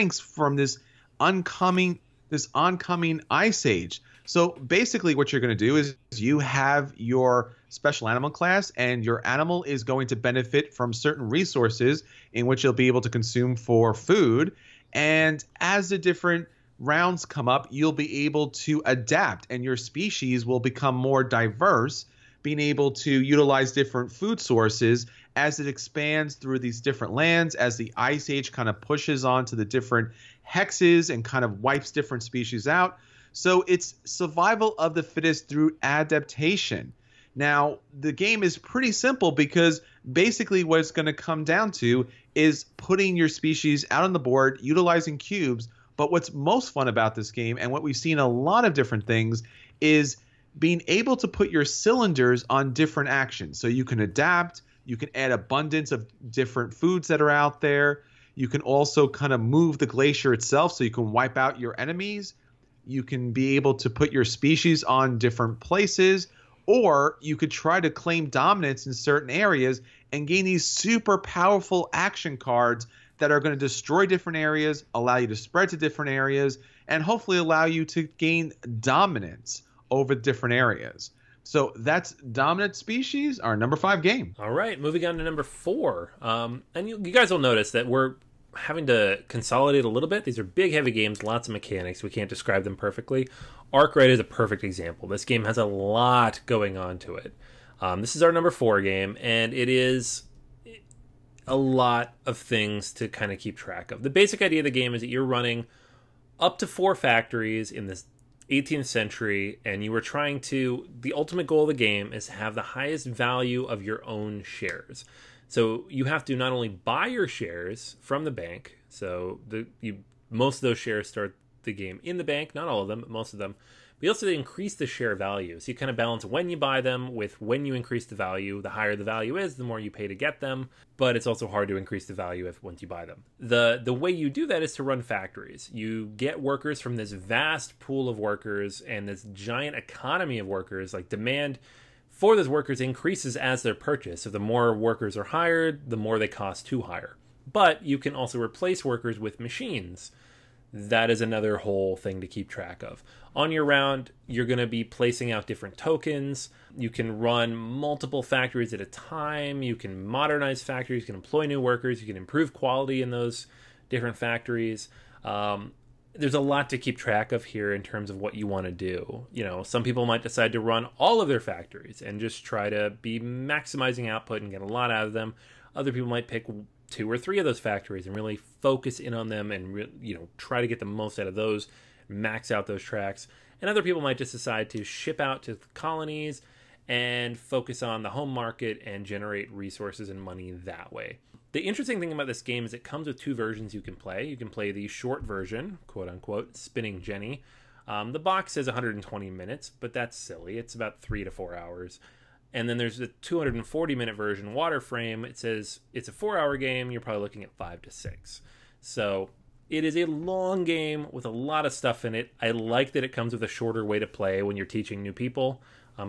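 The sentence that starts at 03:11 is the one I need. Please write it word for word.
The interesting thing about this game is it comes with two versions you can play.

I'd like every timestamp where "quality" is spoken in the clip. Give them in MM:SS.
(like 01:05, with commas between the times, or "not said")
02:42.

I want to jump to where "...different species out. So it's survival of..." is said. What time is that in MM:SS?
00:31.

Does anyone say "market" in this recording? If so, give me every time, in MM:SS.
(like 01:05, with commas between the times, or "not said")
03:08.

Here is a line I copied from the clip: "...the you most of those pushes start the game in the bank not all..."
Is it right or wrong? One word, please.
wrong.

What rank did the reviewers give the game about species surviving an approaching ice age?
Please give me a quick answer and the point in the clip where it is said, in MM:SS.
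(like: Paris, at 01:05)
5, at 01:23.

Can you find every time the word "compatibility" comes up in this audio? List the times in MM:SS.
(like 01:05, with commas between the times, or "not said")
not said.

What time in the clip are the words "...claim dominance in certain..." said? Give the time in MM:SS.
01:07.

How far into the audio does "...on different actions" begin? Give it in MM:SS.
00:52.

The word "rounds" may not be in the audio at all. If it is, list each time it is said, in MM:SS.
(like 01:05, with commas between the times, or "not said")
00:16, 02:33.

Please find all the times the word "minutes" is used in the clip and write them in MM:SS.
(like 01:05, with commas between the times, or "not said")
03:19, 03:23.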